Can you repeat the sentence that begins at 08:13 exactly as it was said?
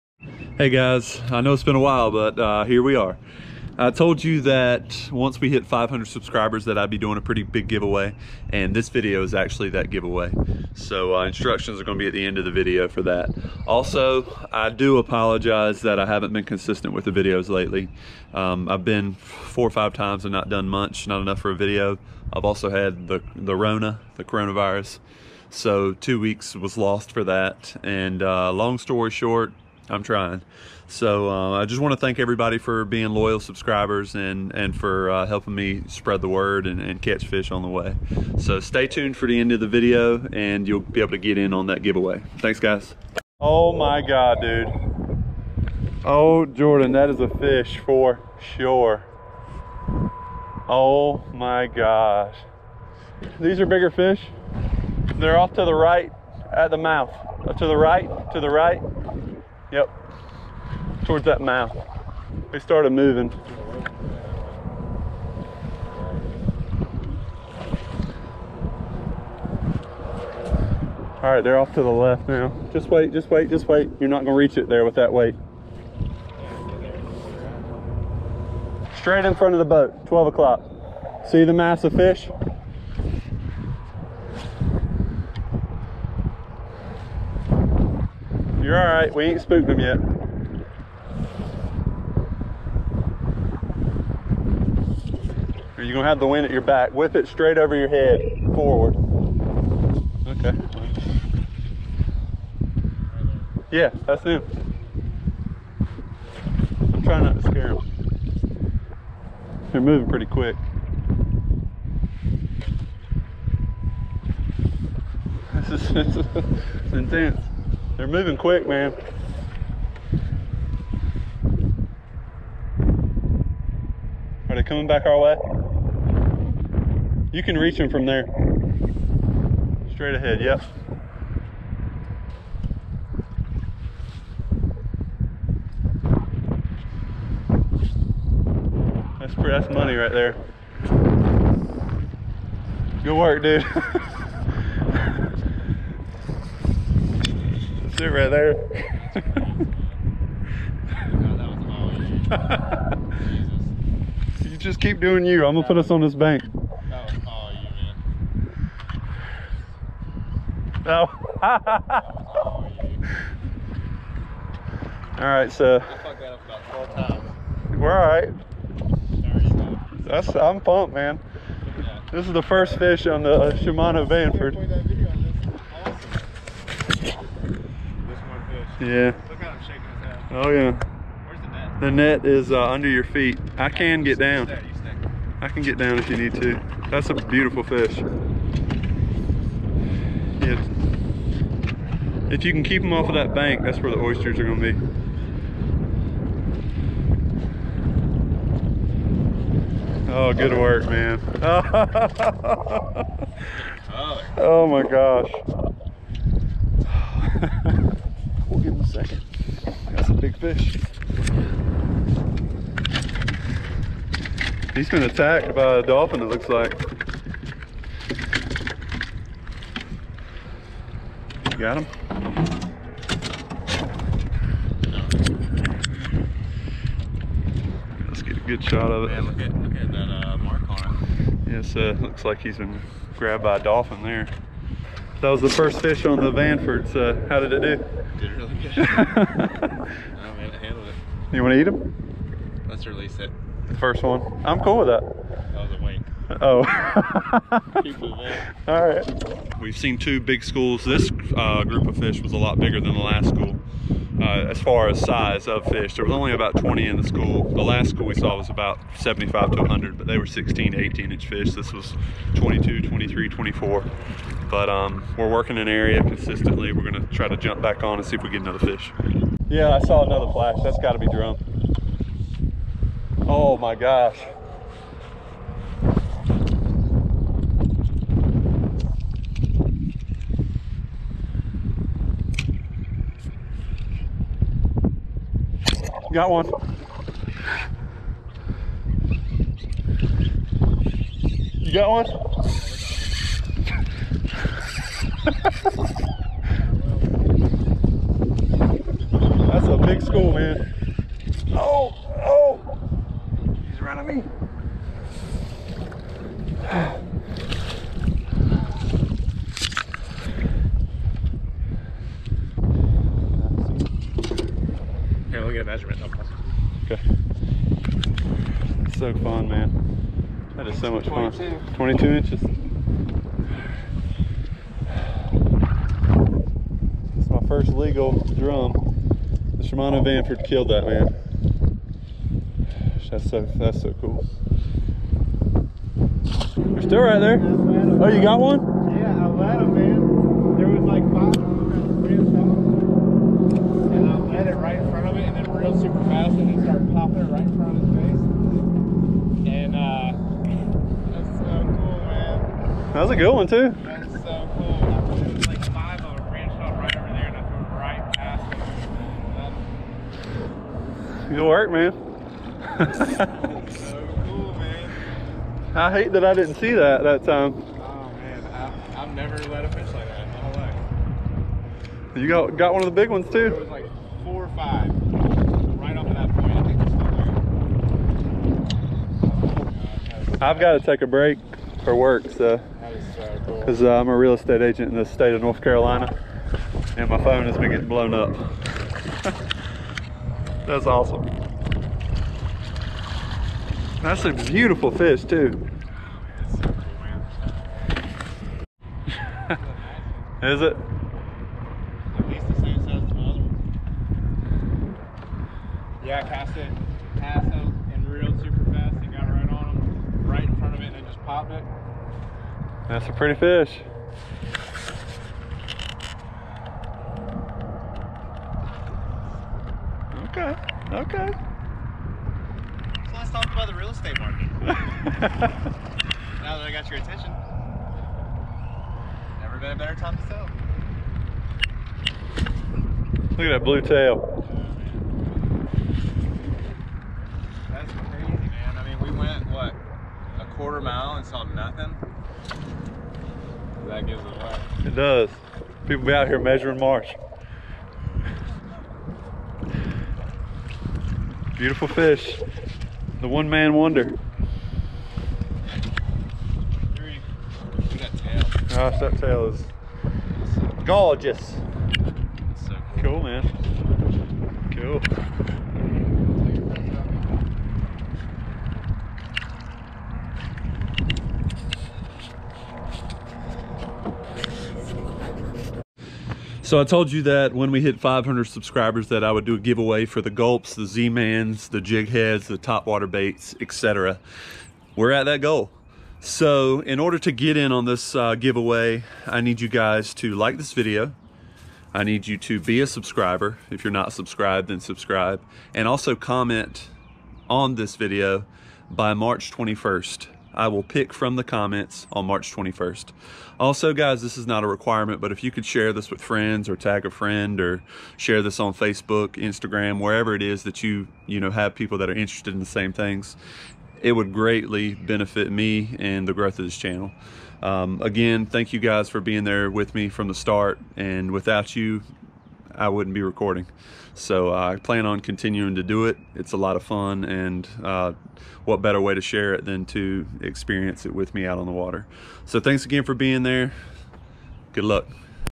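If you're not subscribed, then subscribe.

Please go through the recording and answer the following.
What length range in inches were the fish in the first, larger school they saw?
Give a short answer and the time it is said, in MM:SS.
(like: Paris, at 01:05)
16 to 18 inches, at 04:20.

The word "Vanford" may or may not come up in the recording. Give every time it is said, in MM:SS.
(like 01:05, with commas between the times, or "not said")
02:54, 03:56, 05:30.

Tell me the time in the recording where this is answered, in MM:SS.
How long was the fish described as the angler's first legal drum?
05:21.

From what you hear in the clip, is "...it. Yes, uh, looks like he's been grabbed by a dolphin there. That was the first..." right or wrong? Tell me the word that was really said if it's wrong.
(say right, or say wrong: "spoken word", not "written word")
right.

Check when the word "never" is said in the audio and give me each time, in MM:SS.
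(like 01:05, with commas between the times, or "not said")
06:09, 07:09.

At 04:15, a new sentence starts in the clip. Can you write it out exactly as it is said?
There was only about 20 in the school.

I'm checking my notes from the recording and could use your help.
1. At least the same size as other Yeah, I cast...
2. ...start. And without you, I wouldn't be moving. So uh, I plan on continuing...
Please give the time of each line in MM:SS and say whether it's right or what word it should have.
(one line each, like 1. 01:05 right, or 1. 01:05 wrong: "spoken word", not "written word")
1. 06:42 right
2. 08:40 wrong: "recording", not "moving".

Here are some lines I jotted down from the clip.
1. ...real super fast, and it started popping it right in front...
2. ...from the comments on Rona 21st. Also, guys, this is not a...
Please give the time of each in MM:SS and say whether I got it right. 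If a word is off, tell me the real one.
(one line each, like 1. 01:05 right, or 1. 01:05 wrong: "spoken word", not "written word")
1. 05:45 right
2. 08:21 wrong: "March", not "Rona".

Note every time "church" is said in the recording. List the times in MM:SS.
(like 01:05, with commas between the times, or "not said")
not said.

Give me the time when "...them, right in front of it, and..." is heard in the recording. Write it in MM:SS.
06:49.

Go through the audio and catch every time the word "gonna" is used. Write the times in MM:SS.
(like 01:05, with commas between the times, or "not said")
00:11, 01:14, 01:35, 02:35, 04:26.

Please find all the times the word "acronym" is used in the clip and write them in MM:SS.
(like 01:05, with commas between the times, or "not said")
not said.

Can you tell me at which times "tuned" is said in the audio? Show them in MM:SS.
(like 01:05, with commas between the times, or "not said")
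00:38.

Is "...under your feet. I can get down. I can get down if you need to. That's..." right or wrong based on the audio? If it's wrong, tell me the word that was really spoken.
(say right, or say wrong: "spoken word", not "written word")
right.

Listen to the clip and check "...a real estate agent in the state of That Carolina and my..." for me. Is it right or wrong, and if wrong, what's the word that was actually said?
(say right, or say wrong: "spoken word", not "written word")
wrong: "North", not "That".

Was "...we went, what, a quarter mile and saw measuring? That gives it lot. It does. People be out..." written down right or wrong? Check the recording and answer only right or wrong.
wrong.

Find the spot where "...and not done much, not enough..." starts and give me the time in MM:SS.
00:20.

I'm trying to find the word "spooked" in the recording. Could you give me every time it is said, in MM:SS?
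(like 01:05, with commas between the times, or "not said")
01:29.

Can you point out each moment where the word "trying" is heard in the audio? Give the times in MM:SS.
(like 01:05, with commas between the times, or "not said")
00:30, 01:47.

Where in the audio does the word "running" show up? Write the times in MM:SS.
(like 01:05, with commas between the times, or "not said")
05:03.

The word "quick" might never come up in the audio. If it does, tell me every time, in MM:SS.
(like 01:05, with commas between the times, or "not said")
01:50, 01:58.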